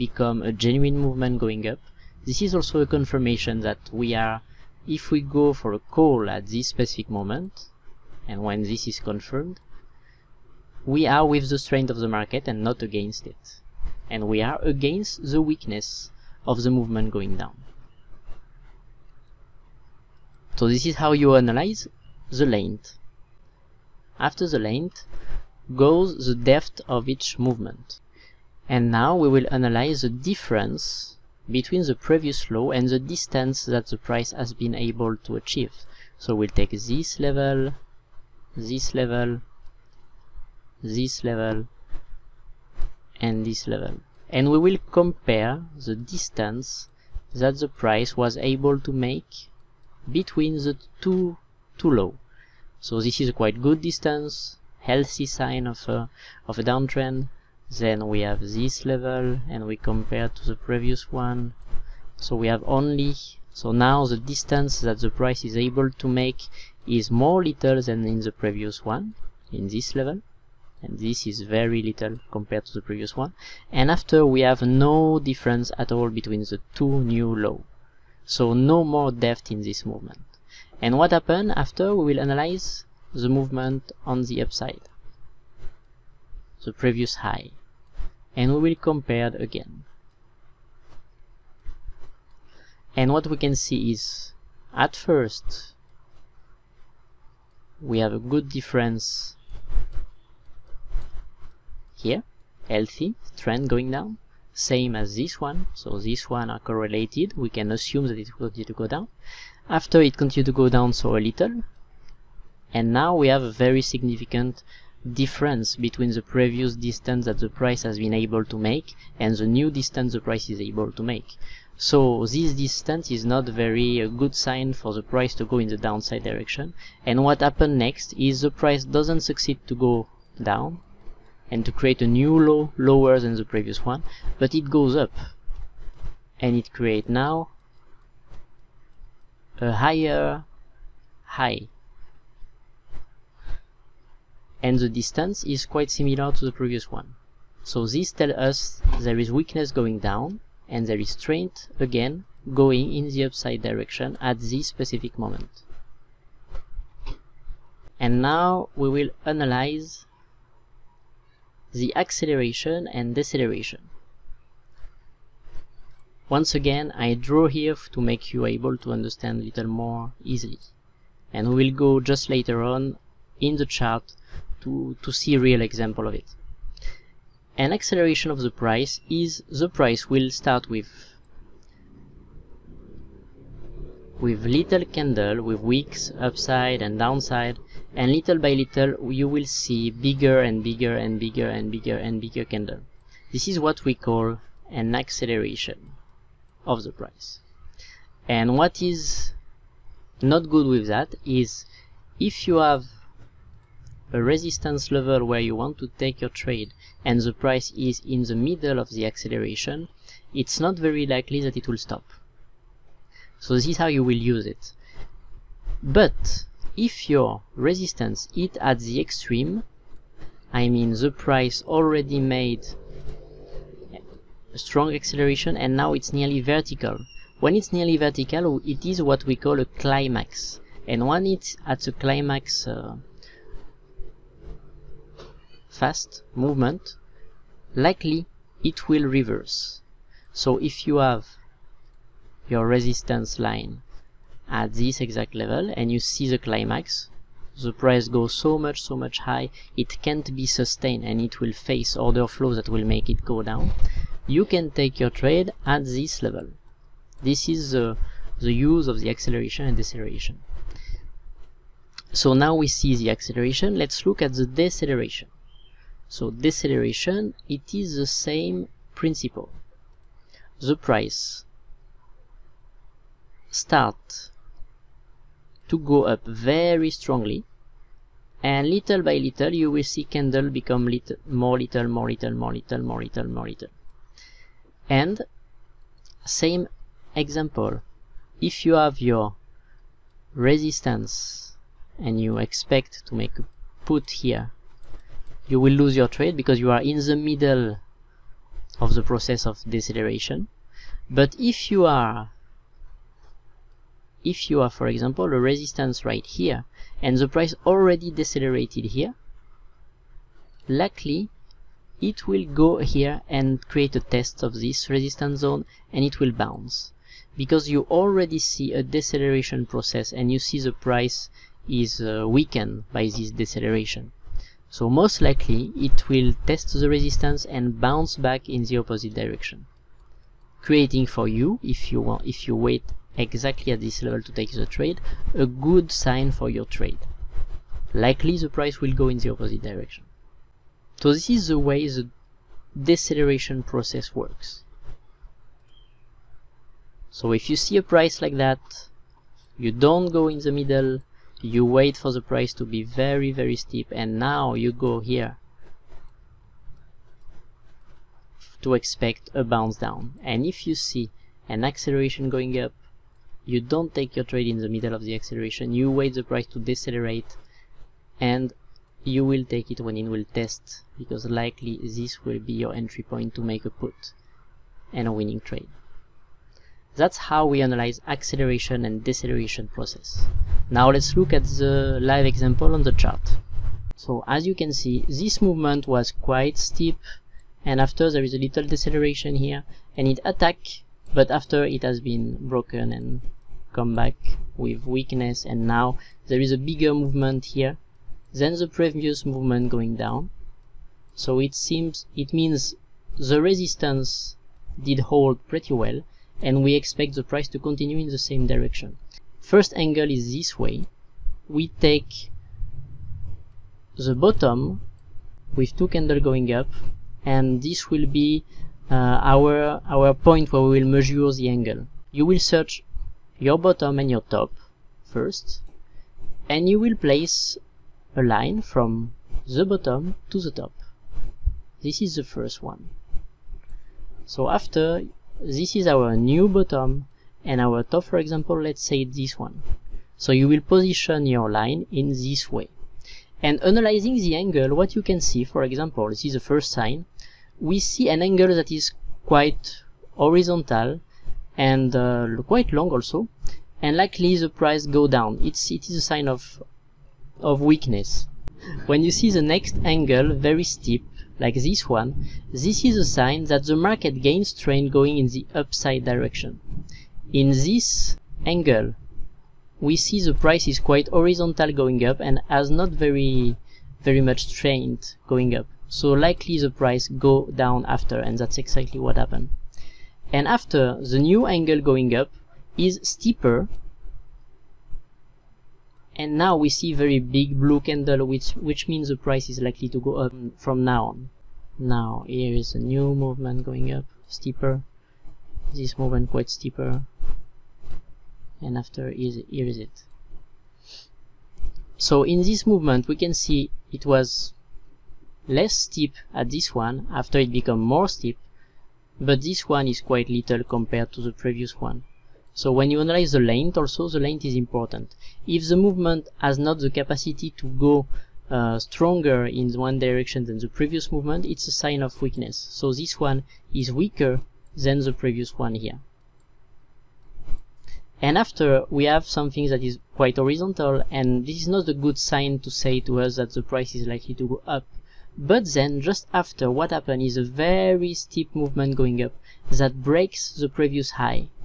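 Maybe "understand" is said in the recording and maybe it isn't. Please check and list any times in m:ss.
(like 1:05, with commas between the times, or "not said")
2:48.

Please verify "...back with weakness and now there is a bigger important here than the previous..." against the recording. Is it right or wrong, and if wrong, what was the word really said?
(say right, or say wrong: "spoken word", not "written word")
wrong: "movement", not "important".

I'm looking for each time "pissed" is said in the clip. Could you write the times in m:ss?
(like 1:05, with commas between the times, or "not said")
not said.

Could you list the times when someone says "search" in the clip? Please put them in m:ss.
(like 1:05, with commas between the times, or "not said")
7:02.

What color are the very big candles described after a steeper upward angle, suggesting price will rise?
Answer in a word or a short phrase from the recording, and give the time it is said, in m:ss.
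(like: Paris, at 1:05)
Blue, at 8:07.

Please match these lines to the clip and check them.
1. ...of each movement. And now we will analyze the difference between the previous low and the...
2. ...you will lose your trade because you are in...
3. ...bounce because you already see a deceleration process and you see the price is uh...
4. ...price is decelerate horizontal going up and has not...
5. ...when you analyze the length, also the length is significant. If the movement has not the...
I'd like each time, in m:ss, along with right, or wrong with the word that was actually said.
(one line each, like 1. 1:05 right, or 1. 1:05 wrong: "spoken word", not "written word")
1. 0:26 right
2. 4:55 right
3. 5:16 right
4. 7:50 wrong: "quite", not "decelerate"
5. 8:32 wrong: "important", not "significant".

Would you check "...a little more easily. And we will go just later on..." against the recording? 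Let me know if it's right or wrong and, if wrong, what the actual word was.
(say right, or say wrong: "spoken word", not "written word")
right.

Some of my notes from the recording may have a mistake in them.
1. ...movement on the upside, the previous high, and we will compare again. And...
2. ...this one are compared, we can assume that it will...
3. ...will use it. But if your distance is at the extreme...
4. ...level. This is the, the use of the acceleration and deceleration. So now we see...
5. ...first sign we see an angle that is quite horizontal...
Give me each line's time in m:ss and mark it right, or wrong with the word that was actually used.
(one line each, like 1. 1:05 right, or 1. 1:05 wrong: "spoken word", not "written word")
1. 1:23 right
2. 1:45 wrong: "correlated", not "compared"
3. 3:34 wrong: "resistance", not "distance"
4. 4:16 right
5. 7:26 right.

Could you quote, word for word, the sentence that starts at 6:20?
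Now let's look at the live example on the chart.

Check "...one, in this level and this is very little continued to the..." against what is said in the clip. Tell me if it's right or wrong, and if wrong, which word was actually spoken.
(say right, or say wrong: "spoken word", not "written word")
wrong: "compared", not "continued".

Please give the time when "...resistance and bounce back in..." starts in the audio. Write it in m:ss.
5:26.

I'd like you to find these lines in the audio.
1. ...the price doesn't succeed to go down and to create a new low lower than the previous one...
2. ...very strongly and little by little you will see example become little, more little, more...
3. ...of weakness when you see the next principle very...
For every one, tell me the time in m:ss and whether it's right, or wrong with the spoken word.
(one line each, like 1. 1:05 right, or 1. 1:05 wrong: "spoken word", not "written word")
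1. 2:08 right
2. 4:36 wrong: "candle", not "example"
3. 7:37 wrong: "angle", not "principle".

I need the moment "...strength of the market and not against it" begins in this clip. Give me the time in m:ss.
0:11.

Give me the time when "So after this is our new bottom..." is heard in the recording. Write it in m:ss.
7:14.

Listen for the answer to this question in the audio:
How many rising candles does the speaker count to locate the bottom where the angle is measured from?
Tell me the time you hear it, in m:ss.
6:55.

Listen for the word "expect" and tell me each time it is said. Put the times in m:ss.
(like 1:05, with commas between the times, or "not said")
4:52, 5:58, 6:46.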